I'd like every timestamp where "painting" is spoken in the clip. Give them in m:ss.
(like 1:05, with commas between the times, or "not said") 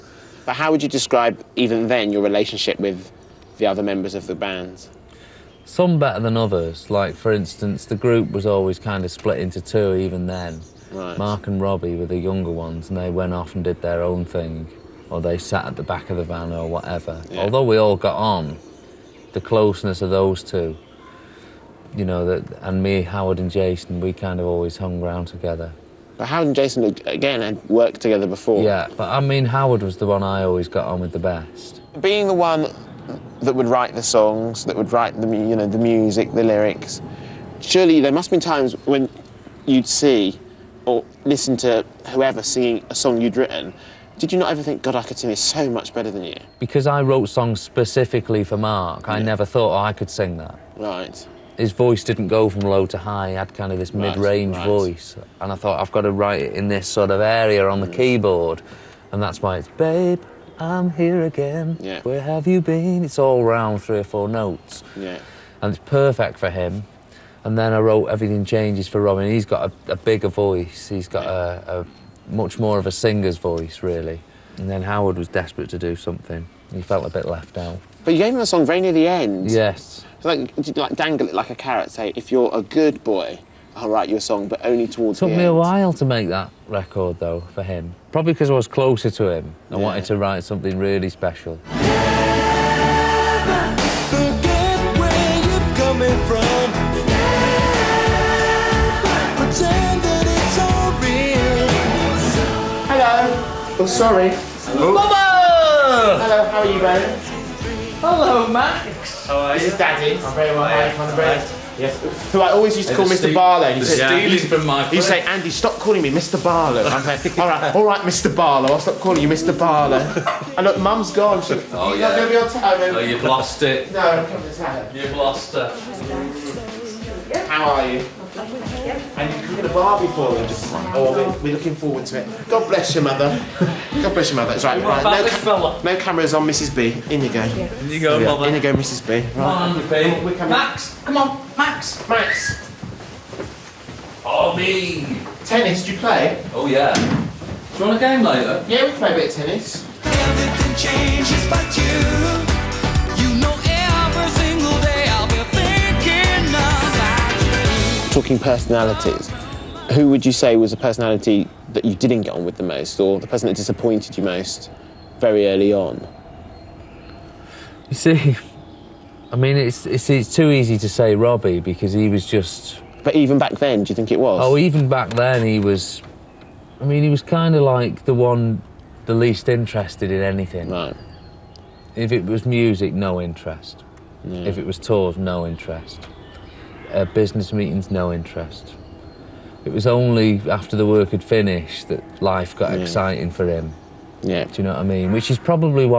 not said.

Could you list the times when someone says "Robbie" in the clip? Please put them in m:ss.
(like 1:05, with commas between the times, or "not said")
0:11, 2:51.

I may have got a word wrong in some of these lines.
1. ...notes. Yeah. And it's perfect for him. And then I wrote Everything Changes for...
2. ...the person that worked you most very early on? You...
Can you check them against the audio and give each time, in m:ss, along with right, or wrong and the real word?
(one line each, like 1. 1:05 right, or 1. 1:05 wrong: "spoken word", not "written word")
1. 1:04 right
2. 2:43 wrong: "disappointed", not "worked".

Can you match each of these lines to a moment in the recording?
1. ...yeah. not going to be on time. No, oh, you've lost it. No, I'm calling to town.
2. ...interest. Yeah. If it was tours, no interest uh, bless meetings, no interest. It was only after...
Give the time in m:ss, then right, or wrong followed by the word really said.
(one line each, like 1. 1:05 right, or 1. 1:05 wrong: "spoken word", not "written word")
1. 2:02 wrong: "coming", not "calling"
2. 3:03 wrong: "business", not "bless".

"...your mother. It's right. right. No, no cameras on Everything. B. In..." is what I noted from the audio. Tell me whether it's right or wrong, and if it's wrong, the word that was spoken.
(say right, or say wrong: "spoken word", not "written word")
wrong: "Mrs", not "Everything".